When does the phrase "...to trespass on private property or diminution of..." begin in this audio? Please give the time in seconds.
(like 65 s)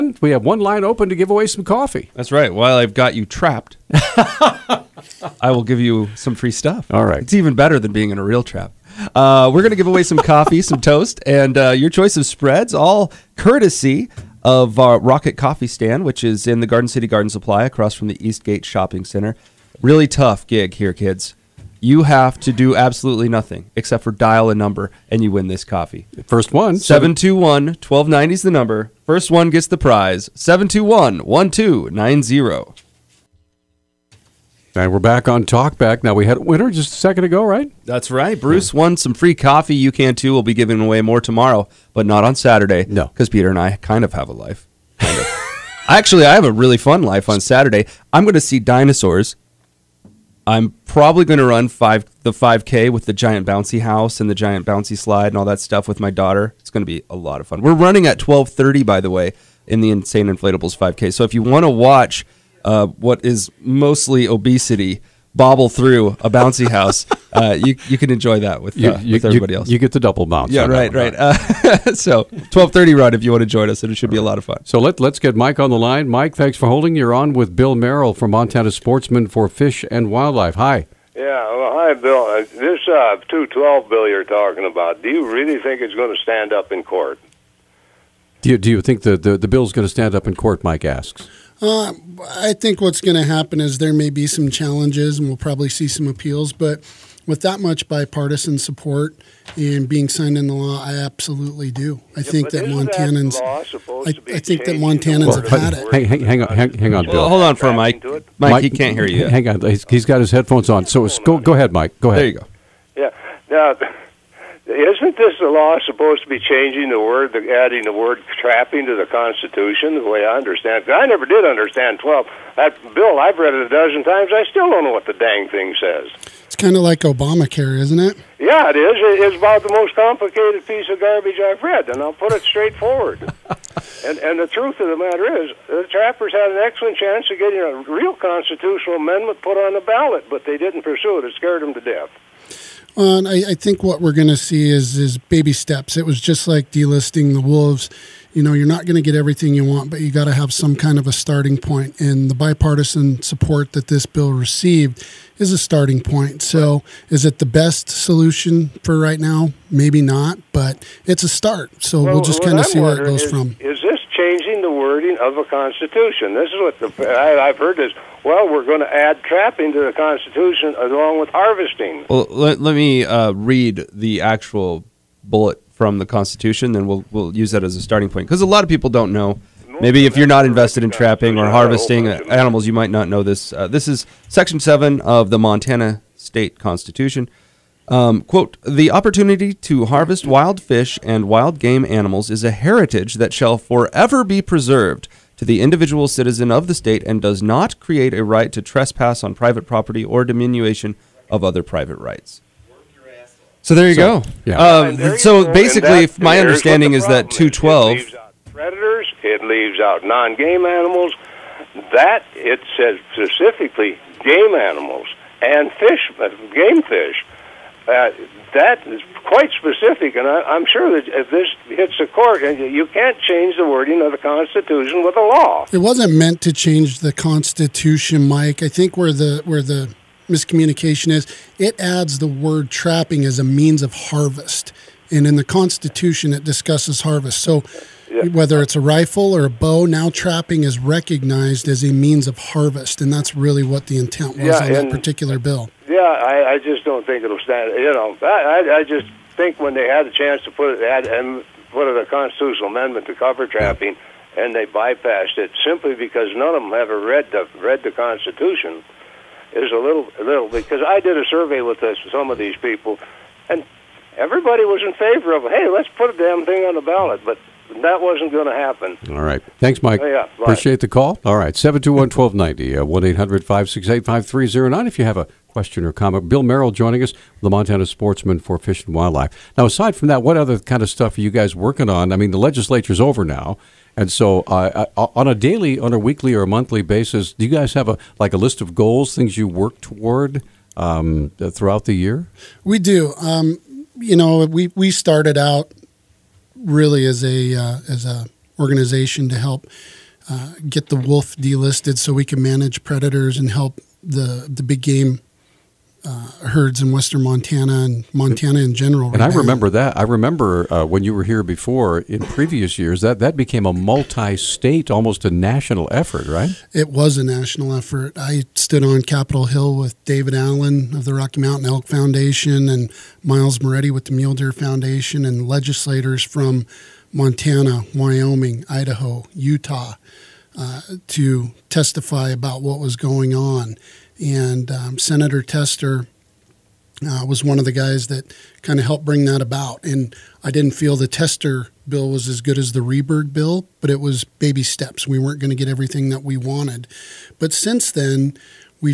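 198 s.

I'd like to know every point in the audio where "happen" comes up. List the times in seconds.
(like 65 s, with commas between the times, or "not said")
93 s, 268 s.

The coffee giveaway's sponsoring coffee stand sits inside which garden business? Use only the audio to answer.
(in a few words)
Garden City Garden Supply.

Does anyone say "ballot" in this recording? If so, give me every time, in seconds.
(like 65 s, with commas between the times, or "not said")
139 s, 266 s.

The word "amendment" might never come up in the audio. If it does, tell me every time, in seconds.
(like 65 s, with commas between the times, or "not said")
138 s, 252 s.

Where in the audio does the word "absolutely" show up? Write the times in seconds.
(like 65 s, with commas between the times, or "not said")
22 s, 100 s.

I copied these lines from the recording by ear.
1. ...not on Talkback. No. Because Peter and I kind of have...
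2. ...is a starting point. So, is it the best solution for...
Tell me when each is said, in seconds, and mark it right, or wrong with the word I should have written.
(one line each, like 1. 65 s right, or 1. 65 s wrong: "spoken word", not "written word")
1. 42 s wrong: "Saturday", not "Talkback"
2. 155 s right.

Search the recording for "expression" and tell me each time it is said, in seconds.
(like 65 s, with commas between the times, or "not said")
not said.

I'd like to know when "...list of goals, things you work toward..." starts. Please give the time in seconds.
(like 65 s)
288 s.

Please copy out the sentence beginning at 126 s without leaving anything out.
It's kind of like Obamacare, isn't it?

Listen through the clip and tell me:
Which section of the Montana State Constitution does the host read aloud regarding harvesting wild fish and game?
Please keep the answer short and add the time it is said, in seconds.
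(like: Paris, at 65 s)
Section Seven, at 184 s.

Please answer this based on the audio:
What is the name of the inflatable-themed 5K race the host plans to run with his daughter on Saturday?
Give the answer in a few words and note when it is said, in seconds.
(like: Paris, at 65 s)
Insane Inflatables, at 59 s.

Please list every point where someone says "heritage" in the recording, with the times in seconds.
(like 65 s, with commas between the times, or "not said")
192 s.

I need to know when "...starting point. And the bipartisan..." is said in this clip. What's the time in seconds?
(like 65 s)
151 s.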